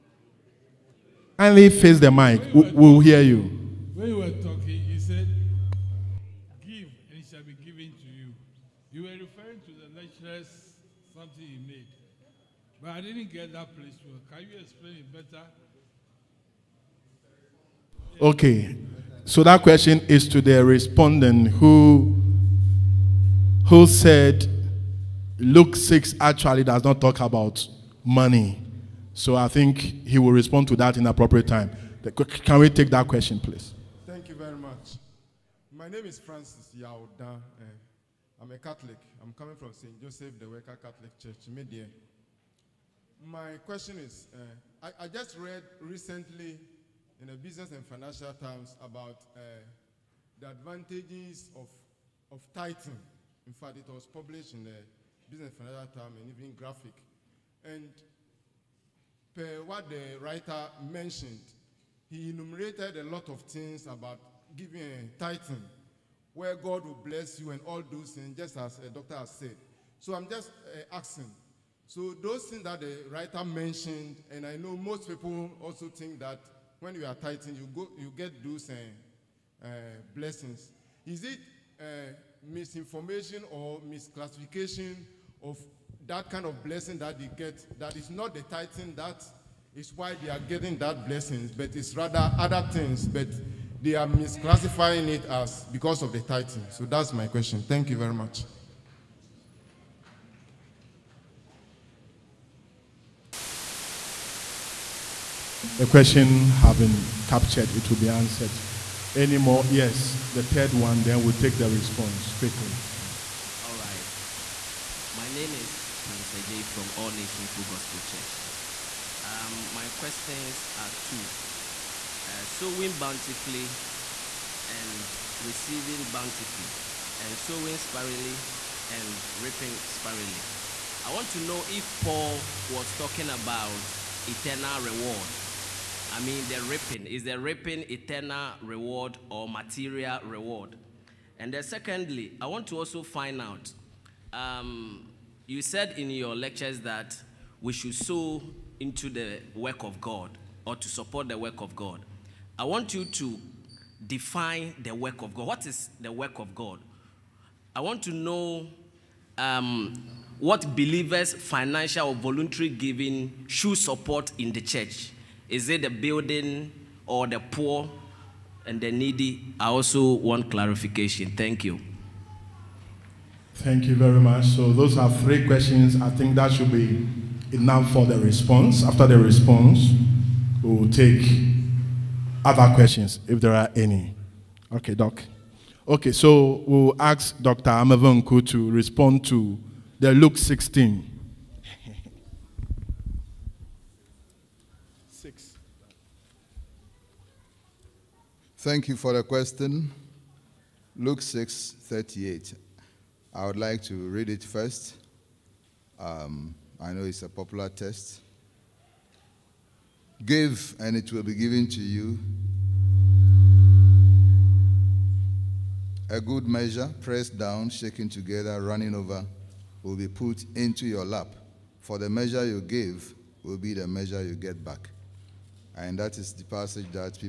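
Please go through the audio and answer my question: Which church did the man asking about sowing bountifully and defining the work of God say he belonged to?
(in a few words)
All Nation Full Gospel Church.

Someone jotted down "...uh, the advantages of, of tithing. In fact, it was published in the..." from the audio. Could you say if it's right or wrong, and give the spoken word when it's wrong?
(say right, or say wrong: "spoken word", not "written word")
right.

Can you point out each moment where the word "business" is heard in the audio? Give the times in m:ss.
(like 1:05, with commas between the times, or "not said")
0:47, 0:55.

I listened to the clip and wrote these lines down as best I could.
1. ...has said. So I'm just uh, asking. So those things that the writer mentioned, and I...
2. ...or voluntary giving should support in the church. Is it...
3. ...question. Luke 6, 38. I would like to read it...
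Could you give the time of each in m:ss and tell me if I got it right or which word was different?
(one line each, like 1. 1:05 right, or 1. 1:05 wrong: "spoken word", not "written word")
1. 1:09 right
2. 2:42 right
3. 3:19 right.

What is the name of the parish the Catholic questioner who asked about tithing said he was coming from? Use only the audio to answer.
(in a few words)
St. Joseph the Worker Catholic Church.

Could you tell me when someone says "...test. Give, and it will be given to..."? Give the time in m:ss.
3:27.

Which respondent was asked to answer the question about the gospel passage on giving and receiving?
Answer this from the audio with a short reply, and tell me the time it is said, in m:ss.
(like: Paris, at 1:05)
Dr. Amevenku, at 3:07.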